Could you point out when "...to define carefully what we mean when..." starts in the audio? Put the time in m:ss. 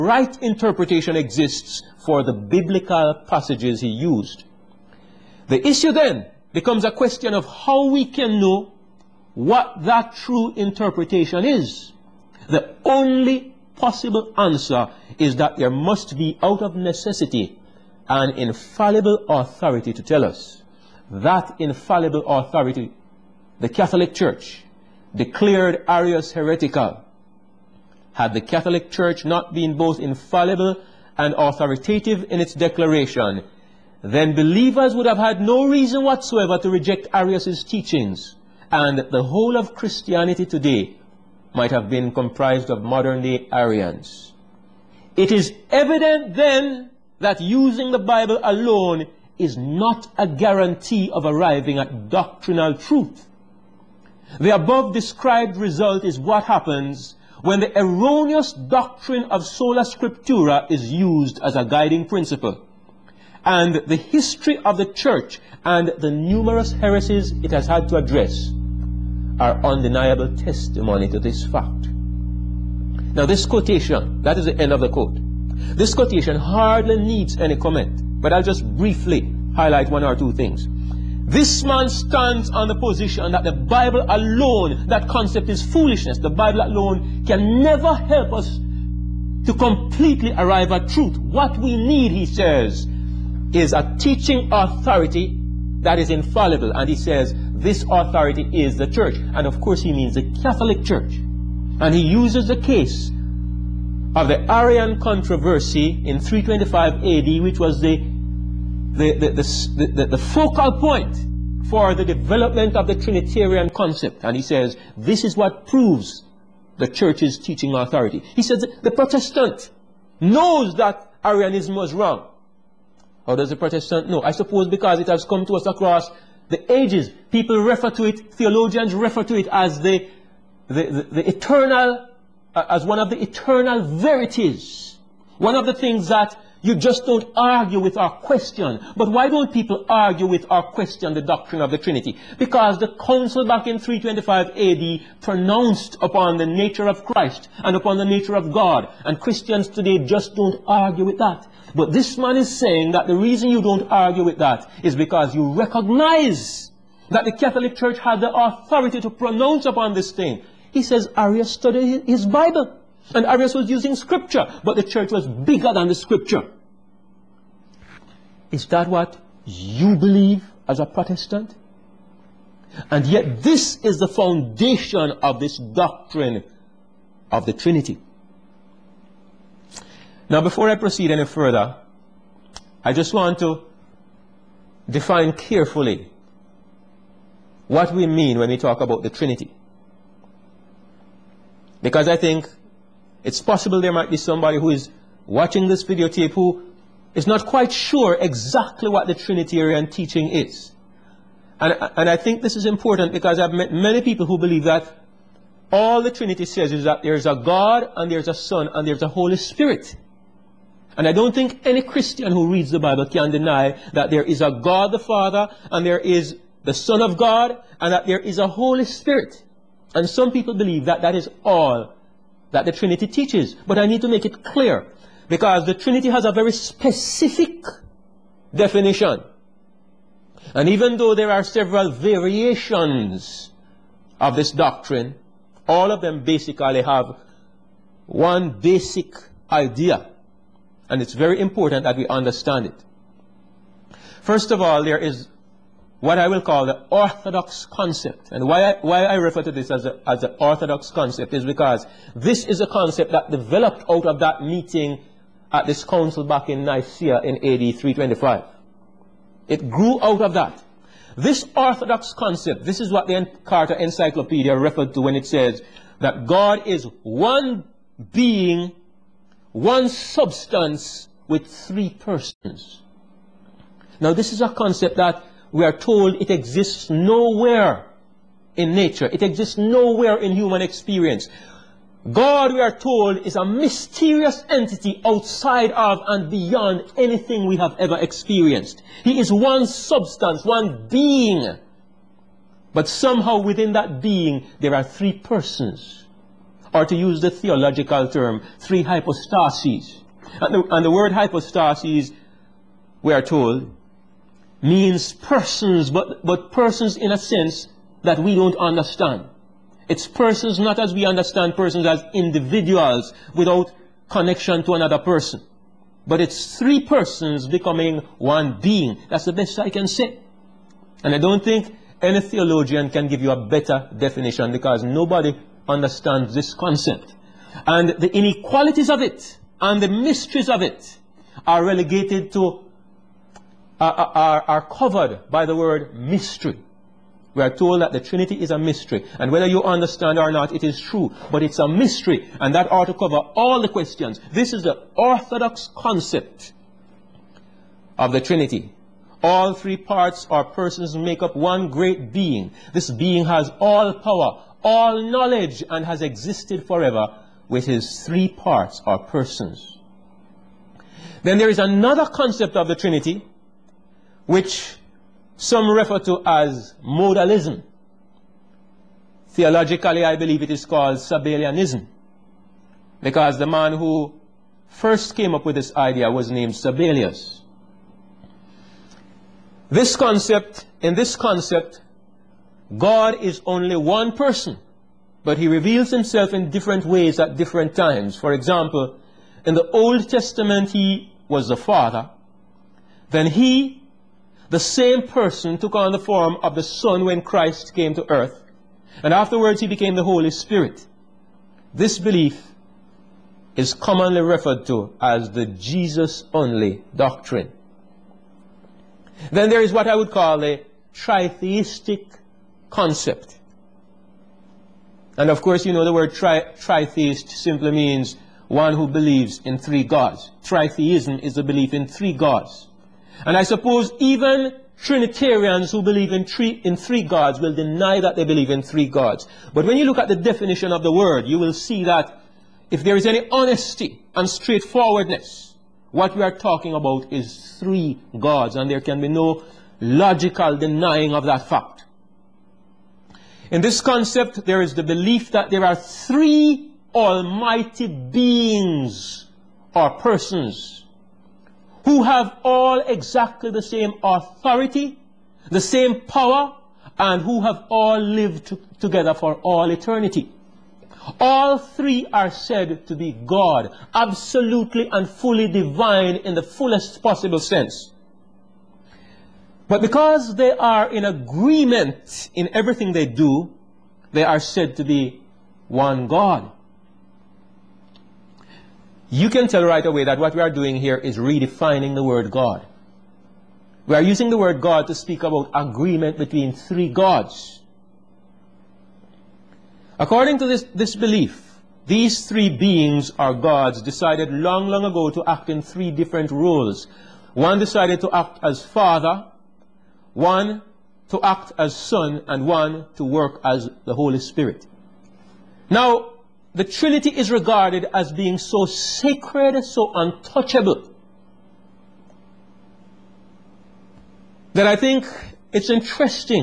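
3:03.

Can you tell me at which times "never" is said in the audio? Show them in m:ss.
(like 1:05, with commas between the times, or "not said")
1:27.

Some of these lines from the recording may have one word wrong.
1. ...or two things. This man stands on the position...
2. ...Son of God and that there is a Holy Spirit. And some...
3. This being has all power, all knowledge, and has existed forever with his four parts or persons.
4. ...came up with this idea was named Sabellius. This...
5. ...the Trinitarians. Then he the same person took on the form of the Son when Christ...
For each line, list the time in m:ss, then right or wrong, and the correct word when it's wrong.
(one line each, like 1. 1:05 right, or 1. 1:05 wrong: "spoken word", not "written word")
1. 1:20 right
2. 3:36 right
3. 5:52 wrong: "three", not "four"
4. 6:15 right
5. 6:31 wrong: "Father", not "Trinitarians".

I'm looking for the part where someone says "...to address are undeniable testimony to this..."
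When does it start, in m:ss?
1:07.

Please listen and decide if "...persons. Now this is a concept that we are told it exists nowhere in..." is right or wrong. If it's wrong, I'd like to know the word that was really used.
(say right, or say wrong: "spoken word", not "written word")
right.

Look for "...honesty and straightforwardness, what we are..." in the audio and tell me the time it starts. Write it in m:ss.
7:13.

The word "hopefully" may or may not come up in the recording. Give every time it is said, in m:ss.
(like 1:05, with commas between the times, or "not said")
not said.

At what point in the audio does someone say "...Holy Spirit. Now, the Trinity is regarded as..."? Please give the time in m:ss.
8:23.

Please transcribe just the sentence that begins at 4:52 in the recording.
But somehow within that being, there are three persons.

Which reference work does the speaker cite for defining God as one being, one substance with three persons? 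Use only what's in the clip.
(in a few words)
Encarta Encyclopedia.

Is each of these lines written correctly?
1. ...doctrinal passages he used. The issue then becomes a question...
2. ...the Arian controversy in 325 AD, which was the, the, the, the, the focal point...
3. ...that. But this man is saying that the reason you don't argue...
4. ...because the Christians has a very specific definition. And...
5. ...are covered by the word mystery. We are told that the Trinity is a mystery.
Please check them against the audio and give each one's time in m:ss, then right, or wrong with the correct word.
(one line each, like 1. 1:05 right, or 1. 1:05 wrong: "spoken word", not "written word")
1. 0:02 wrong: "biblical", not "doctrinal"
2. 1:44 right
3. 2:31 right
4. 3:45 wrong: "Trinity", not "Christians"
5. 5:34 right.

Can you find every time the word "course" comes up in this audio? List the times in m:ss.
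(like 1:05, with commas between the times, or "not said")
1:39, 6:55.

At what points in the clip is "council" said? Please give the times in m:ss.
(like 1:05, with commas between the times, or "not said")
2:22, 4:15.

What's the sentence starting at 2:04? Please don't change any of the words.
I suppose because it has come to us across the ages.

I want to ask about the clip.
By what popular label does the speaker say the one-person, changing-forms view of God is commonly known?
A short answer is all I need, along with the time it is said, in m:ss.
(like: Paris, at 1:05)
Jesus only doctrine, at 6:45.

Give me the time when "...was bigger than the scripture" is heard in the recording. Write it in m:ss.
2:45.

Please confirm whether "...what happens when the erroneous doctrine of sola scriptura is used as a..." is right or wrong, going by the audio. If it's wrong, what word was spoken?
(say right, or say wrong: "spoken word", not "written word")
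right.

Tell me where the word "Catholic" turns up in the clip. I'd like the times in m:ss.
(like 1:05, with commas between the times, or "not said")
0:23, 0:28, 1:40, 2:37.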